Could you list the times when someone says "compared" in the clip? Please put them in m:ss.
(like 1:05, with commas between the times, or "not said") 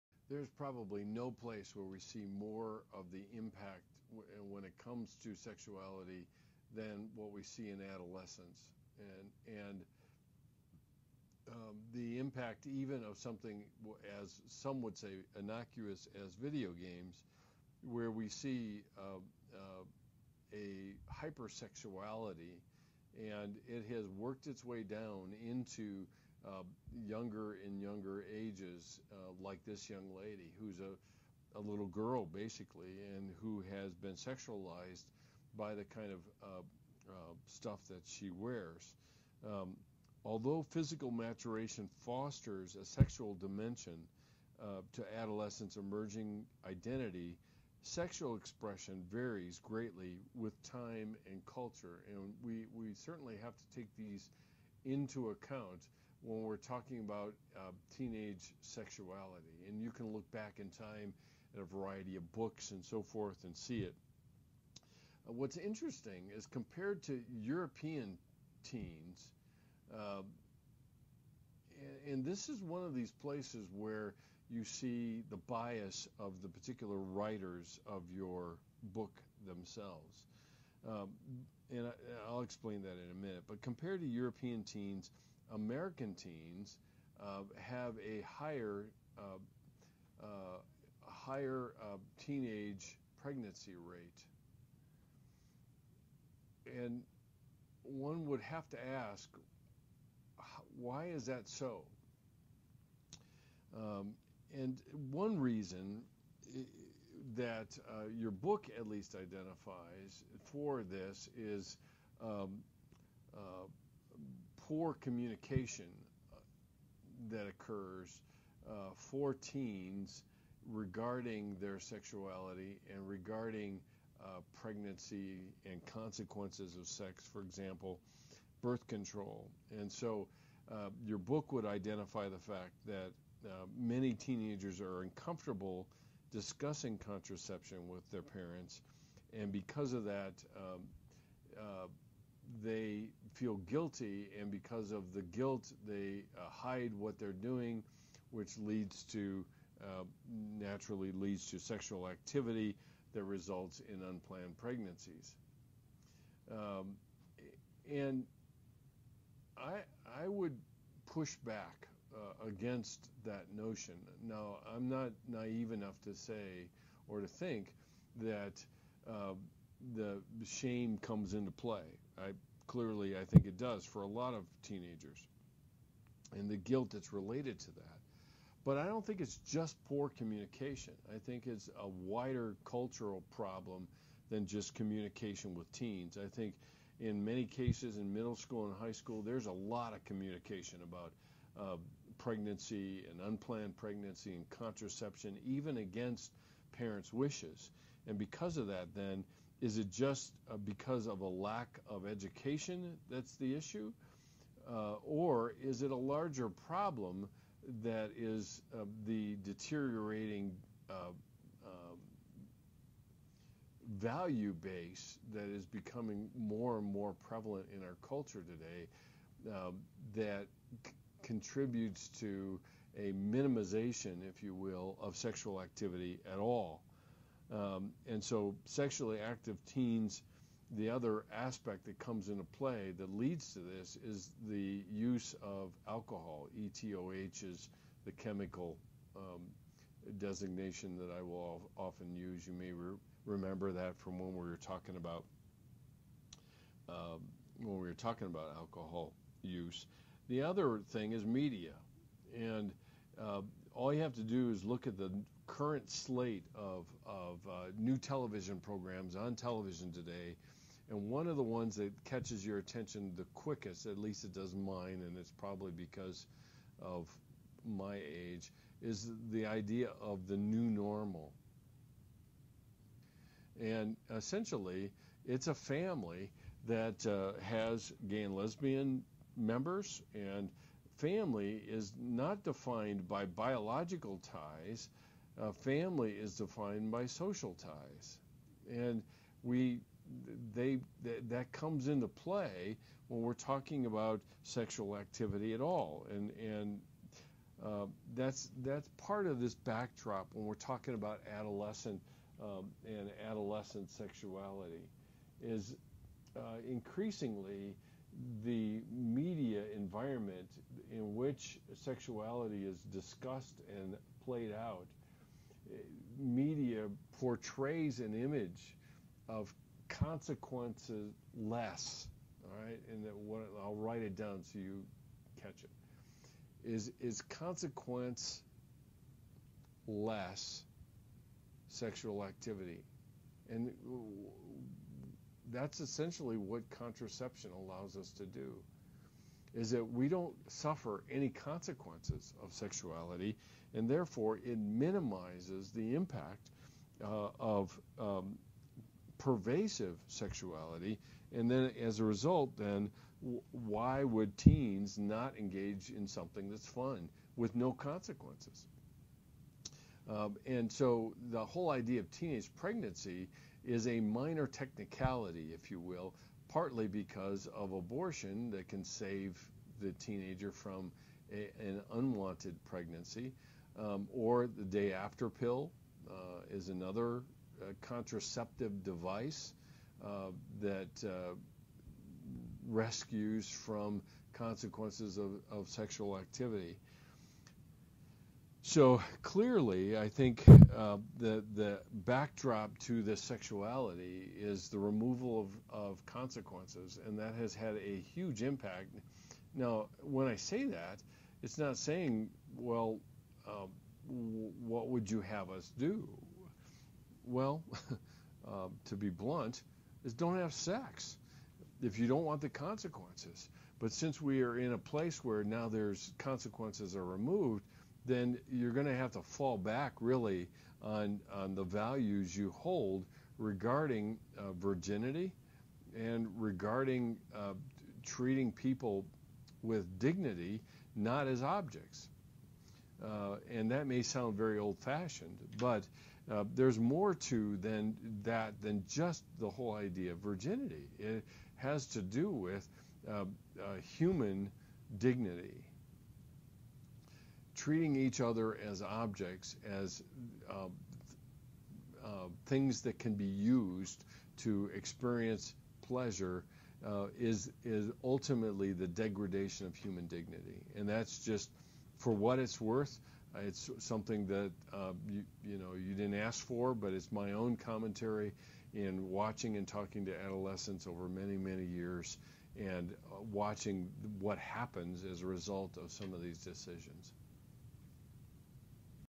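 1:06, 1:23.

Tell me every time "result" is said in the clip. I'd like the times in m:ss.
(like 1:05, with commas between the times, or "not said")
2:33, 5:52, 7:55.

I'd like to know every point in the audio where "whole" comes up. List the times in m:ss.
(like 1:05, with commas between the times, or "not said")
6:01, 7:19.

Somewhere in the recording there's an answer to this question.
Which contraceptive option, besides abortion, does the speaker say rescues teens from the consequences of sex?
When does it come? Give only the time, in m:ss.
6:14.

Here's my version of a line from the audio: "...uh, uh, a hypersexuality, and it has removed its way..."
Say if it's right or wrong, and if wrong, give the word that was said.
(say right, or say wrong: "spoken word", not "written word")
wrong: "worked", not "removed".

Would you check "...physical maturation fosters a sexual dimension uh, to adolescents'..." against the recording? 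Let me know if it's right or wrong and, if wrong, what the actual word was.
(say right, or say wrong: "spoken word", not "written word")
right.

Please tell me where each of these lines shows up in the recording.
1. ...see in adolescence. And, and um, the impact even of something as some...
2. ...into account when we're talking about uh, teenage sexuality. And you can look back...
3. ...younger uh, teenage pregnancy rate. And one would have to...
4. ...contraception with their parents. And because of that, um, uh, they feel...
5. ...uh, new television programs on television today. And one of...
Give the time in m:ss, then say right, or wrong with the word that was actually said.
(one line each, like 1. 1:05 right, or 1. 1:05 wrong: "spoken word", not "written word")
1. 0:07 right
2. 0:54 right
3. 1:31 wrong: "higher", not "younger"
4. 2:16 right
5. 4:17 right.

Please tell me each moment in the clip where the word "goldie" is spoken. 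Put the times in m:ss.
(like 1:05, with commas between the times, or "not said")
not said.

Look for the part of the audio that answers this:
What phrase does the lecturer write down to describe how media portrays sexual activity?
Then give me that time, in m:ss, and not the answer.
5:27.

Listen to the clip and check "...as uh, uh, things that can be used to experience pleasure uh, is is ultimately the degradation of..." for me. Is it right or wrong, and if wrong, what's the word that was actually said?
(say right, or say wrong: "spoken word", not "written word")
right.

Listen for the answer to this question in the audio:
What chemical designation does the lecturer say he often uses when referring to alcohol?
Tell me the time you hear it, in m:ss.
3:56.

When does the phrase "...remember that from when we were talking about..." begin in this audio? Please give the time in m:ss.
4:03.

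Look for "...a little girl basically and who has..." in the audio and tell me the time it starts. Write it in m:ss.
0:31.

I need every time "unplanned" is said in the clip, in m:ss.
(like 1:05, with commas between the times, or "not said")
2:34, 3:13.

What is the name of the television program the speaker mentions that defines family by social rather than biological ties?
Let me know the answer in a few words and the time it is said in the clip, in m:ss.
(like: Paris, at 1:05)
The New Normal, at 4:30.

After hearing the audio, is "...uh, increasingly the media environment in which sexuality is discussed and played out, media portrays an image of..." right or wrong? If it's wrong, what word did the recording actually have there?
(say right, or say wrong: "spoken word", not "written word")
right.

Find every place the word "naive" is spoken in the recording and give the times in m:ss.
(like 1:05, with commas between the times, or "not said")
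2:45.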